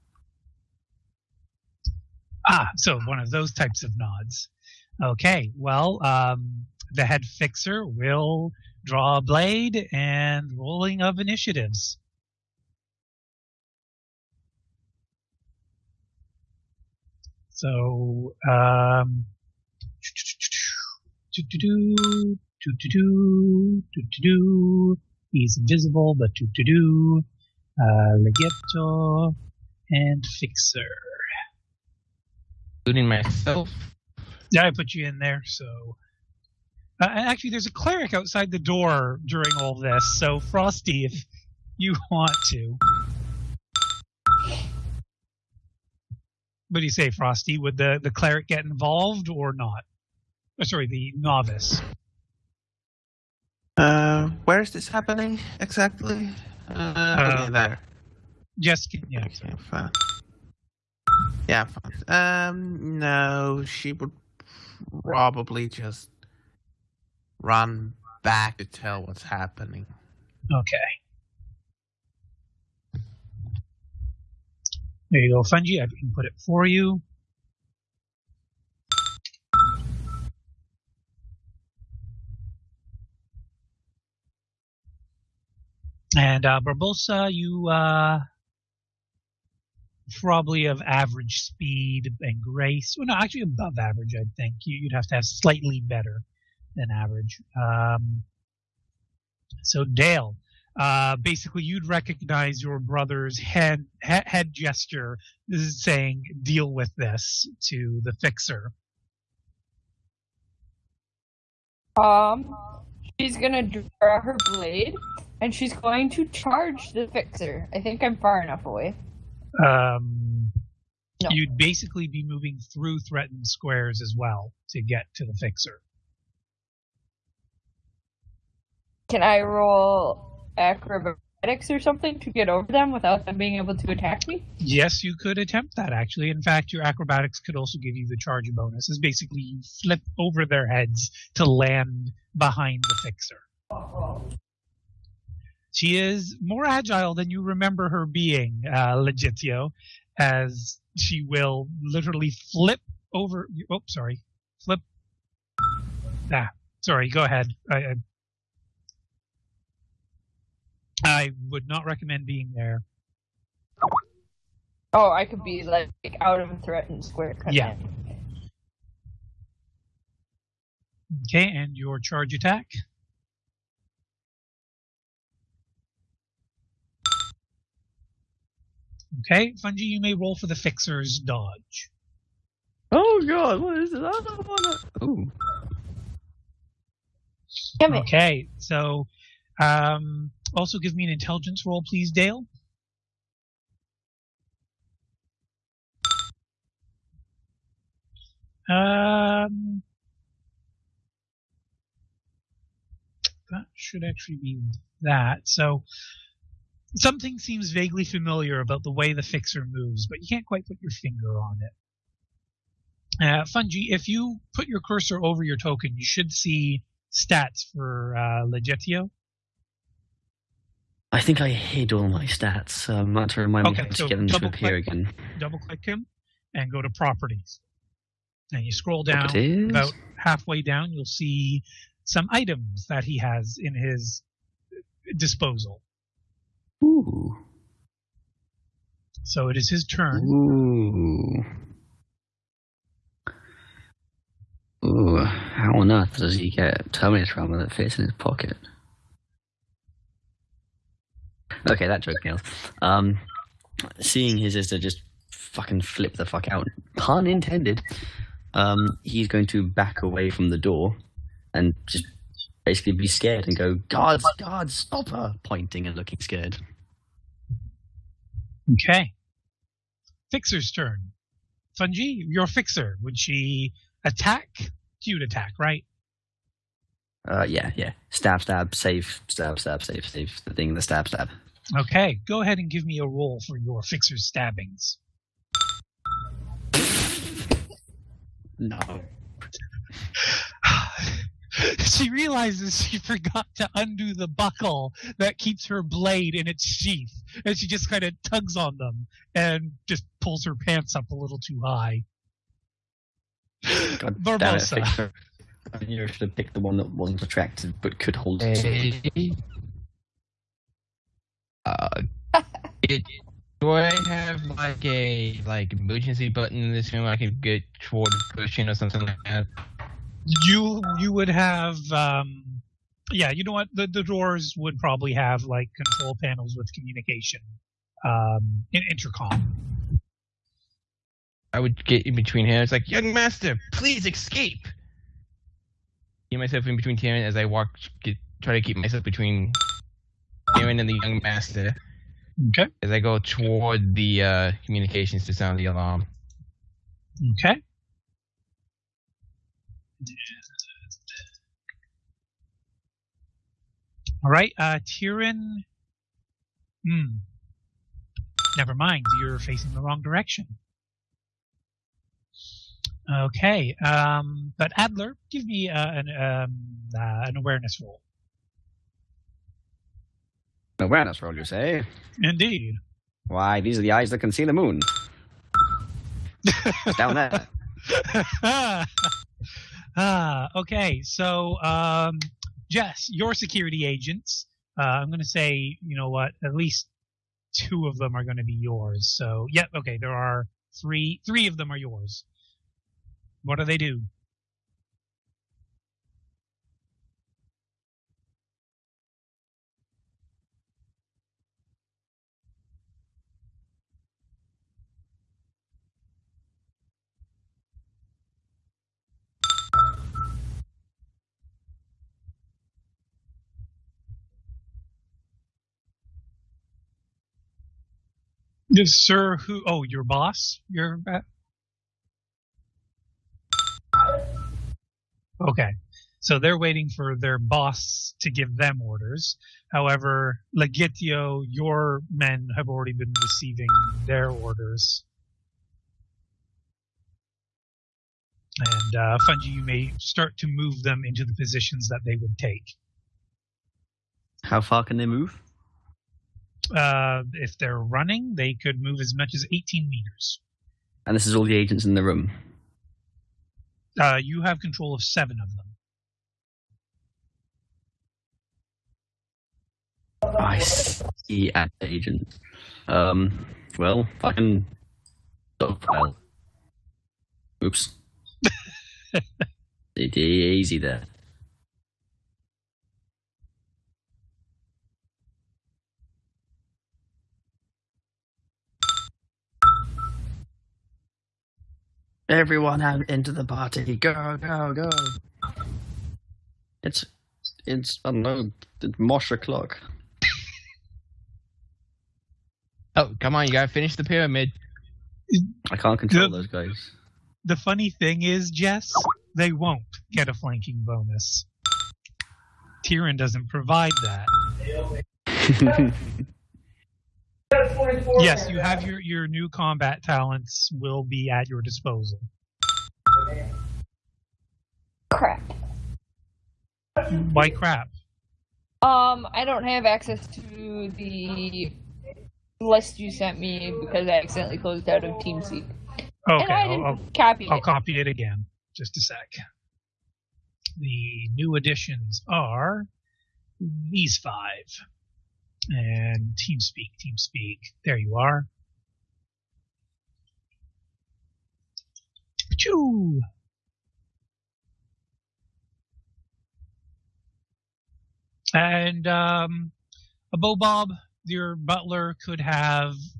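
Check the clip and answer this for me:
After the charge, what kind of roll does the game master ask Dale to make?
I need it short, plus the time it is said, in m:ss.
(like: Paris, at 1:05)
Intelligence, at 3:11.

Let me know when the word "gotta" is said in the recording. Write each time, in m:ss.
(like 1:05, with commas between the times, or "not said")
8:13.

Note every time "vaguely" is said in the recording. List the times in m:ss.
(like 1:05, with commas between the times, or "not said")
3:27.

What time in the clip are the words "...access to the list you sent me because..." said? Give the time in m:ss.
8:39.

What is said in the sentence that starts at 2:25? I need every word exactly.
She is more agile than you remember her being, uh, Legitio, as she will literally flip over.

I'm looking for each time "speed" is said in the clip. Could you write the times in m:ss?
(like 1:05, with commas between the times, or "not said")
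1:31.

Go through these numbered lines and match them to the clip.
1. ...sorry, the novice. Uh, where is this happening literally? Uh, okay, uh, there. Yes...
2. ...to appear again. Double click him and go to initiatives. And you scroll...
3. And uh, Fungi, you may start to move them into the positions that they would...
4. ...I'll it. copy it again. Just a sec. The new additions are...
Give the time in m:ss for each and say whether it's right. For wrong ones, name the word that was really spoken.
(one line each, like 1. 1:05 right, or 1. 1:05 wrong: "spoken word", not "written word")
1. 0:50 wrong: "exactly", not "literally"
2. 3:44 wrong: "properties", not "initiatives"
3. 7:18 right
4. 8:47 right.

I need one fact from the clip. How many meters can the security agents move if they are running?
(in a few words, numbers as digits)
18.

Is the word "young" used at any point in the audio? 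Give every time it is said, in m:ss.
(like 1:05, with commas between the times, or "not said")
5:32, 5:41.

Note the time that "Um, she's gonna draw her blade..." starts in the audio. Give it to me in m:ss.
1:52.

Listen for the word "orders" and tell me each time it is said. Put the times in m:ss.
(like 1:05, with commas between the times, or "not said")
7:08, 7:14.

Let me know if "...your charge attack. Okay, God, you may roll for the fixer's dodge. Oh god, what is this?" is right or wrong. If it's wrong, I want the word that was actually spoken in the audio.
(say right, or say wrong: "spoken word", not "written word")
wrong: "Fungi", not "God".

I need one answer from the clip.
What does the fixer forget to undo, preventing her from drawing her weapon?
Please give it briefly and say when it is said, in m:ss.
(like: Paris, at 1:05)
The buckle, at 4:54.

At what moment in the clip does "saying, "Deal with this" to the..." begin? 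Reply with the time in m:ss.
1:45.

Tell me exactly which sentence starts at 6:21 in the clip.
So, um, Jess, your security agents.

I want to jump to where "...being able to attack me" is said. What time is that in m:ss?
2:13.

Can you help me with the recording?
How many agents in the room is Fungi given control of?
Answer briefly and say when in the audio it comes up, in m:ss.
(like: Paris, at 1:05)
7, at 7:35.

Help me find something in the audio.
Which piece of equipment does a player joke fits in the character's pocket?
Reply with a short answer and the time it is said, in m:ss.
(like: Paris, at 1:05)
Terminator armor, at 4:06.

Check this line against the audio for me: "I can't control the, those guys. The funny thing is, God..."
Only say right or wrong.
wrong.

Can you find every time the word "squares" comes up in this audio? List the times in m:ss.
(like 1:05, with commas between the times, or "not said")
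2:03, 2:47.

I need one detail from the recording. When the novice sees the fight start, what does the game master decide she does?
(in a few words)
Run back to tell.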